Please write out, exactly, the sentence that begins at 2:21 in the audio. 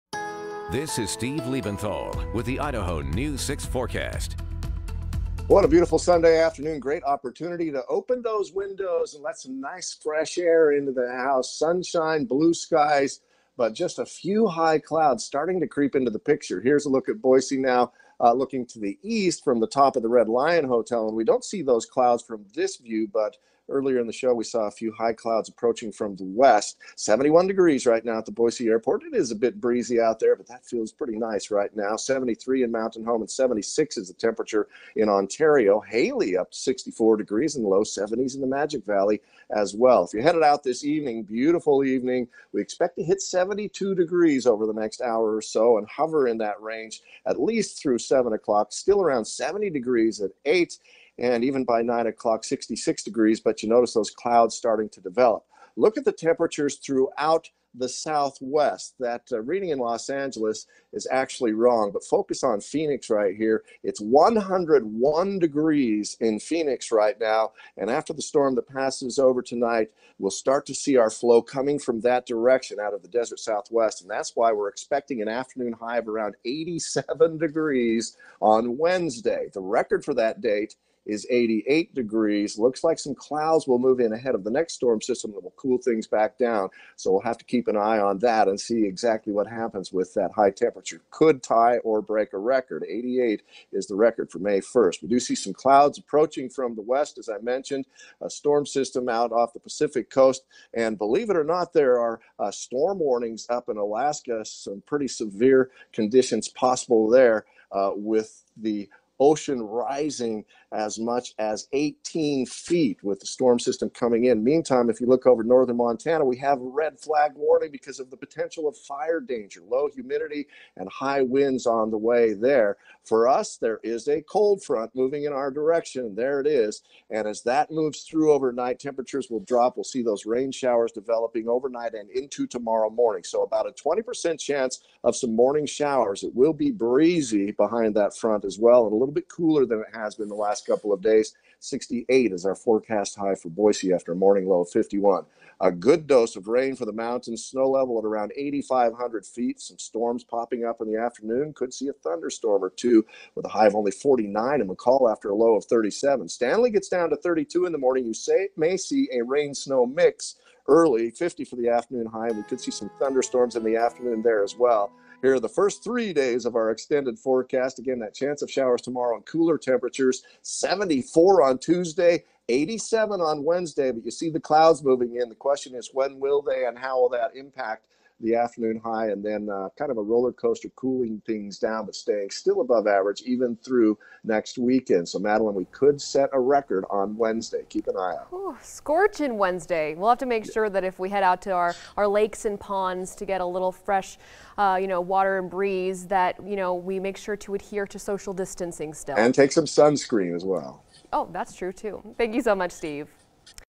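68 is our forecast high for Boise after a morning low of 51.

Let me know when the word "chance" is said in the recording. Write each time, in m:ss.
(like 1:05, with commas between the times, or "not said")
2:14, 2:48.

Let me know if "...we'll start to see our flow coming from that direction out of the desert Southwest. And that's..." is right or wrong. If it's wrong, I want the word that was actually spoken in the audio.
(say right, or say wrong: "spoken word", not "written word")
right.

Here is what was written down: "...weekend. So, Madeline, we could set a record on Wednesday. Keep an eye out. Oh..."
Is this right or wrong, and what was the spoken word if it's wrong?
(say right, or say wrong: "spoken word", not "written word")
right.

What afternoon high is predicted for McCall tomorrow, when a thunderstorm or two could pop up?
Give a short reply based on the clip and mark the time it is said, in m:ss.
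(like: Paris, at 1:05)
49, at 2:33.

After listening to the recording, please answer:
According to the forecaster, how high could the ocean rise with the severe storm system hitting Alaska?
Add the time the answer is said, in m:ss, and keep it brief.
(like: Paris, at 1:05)
18 feet, at 1:51.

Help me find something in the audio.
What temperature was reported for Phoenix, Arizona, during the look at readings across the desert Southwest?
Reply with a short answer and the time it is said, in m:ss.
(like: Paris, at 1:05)
101 degrees, at 1:04.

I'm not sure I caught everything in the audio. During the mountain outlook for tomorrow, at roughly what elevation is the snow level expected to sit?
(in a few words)
8,500 feet.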